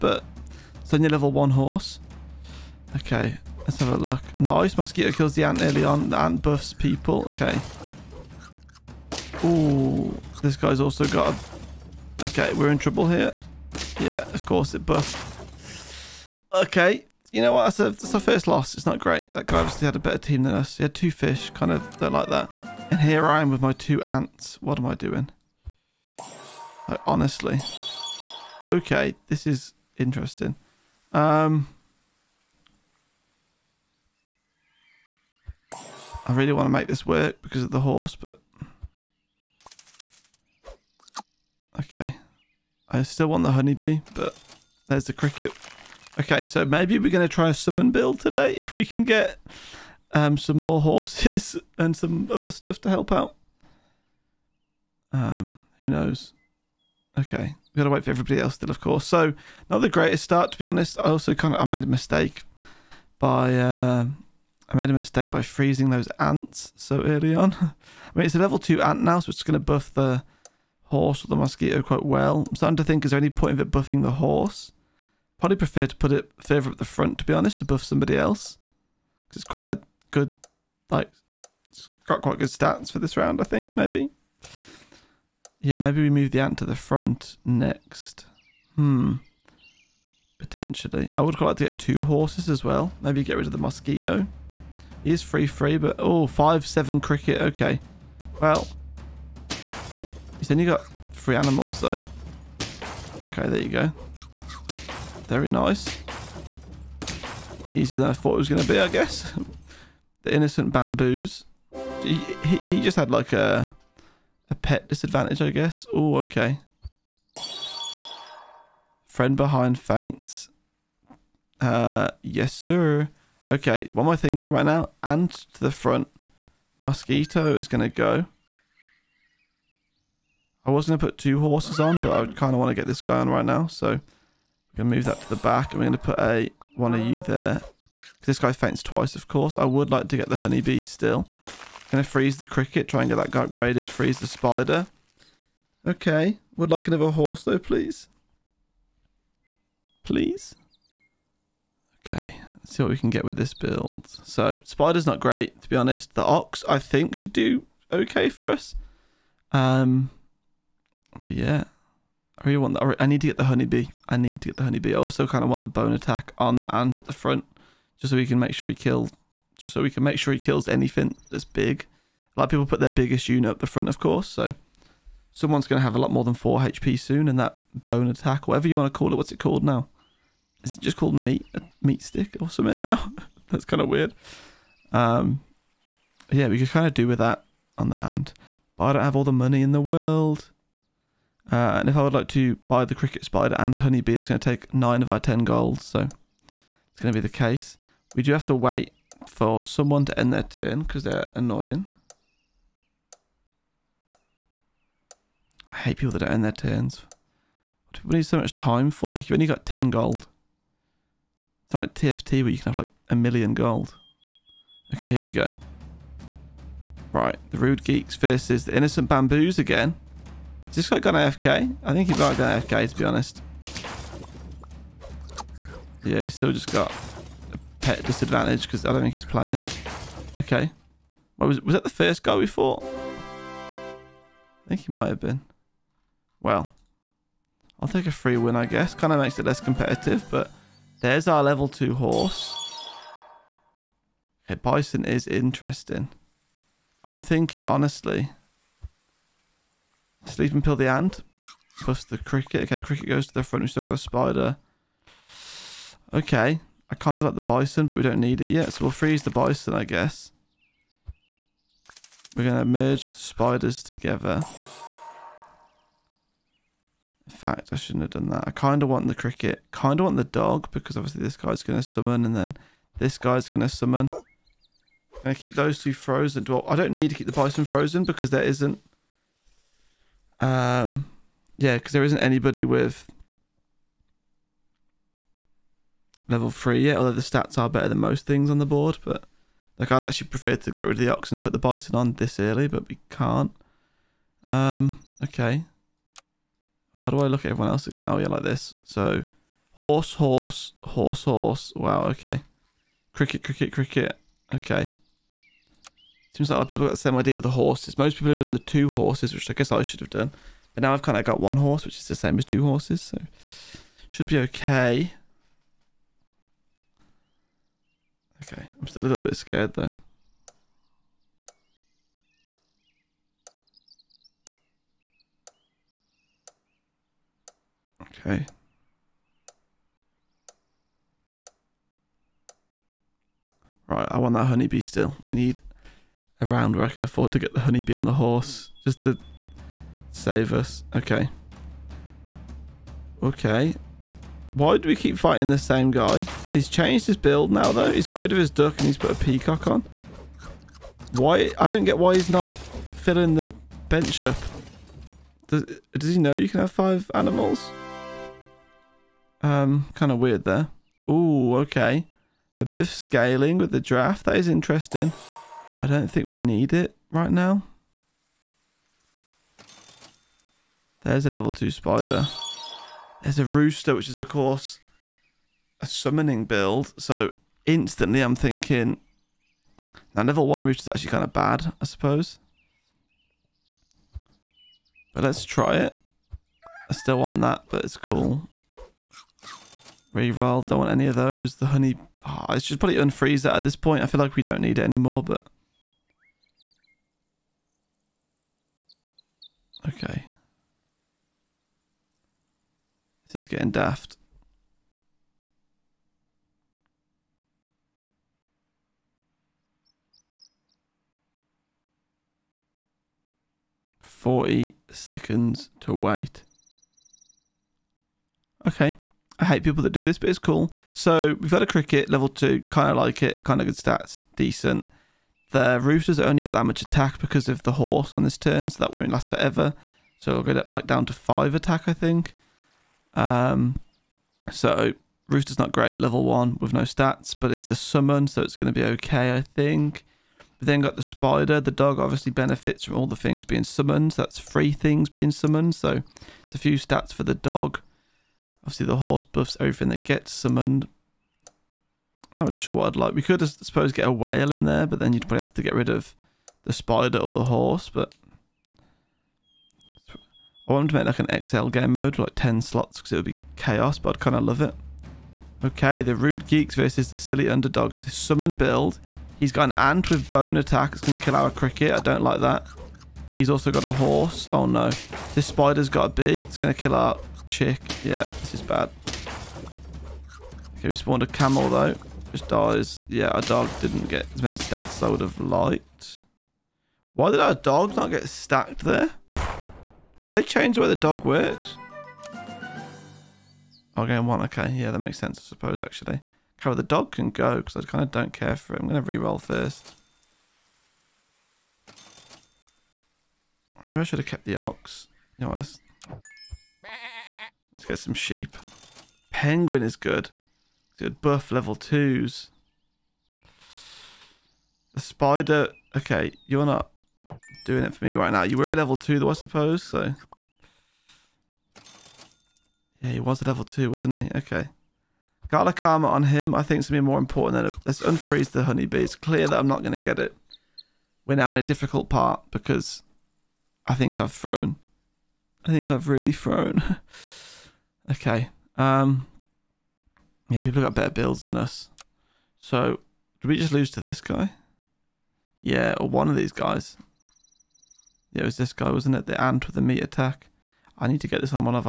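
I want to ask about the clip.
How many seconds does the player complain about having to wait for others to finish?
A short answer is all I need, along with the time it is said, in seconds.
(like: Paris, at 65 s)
40, at 414 s.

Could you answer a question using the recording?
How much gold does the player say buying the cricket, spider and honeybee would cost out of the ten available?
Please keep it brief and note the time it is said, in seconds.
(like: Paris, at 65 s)
9, at 194 s.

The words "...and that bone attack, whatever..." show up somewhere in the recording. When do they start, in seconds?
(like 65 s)
177 s.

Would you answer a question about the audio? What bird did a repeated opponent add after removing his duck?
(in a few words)
peacock.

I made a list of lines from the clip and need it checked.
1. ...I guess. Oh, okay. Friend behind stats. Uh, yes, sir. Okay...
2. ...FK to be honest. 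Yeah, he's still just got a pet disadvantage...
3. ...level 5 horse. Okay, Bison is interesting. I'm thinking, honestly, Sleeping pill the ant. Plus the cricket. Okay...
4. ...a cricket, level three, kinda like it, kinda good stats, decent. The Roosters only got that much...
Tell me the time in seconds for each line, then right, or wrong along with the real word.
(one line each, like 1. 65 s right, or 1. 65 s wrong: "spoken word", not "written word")
1. 115 s wrong: "faints", not "stats"
2. 222 s right
3. 241 s wrong: "2", not "5"
4. 421 s wrong: "two", not "three".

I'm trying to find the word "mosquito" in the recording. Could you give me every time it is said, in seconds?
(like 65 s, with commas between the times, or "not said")
4 s, 71 s, 93 s, 126 s.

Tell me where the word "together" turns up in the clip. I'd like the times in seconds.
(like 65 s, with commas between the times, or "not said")
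263 s.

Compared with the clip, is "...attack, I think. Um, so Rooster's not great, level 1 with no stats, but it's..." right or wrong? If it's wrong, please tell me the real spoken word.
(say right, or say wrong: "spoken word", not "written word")
right.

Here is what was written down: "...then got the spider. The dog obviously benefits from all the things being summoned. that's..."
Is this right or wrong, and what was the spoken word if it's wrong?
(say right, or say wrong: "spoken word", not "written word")
right.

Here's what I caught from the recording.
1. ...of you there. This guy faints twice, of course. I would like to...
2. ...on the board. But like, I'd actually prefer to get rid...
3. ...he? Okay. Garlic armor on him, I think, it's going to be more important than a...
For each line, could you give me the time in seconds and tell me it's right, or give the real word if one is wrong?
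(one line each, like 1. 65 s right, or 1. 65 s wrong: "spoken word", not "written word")
1. 136 s right
2. 288 s right
3. 524 s right.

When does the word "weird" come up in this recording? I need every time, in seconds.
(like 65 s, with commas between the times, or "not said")
183 s, 360 s.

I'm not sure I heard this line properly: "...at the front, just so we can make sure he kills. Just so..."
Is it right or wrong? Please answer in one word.
right.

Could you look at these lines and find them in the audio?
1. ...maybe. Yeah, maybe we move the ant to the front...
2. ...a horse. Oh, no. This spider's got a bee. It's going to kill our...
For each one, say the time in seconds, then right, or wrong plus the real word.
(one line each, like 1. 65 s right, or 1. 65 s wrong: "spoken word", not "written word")
1. 83 s right
2. 473 s right.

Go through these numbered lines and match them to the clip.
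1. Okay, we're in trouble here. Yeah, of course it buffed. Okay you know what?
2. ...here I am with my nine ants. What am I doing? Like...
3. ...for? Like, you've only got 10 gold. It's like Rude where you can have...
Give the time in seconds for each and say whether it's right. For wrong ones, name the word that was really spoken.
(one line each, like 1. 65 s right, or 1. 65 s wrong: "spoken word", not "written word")
1. 12 s right
2. 23 s wrong: "two", not "nine"
3. 208 s wrong: "TFT", not "Rude".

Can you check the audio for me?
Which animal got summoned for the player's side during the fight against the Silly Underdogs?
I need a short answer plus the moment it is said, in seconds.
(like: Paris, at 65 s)
camel, at 481 s.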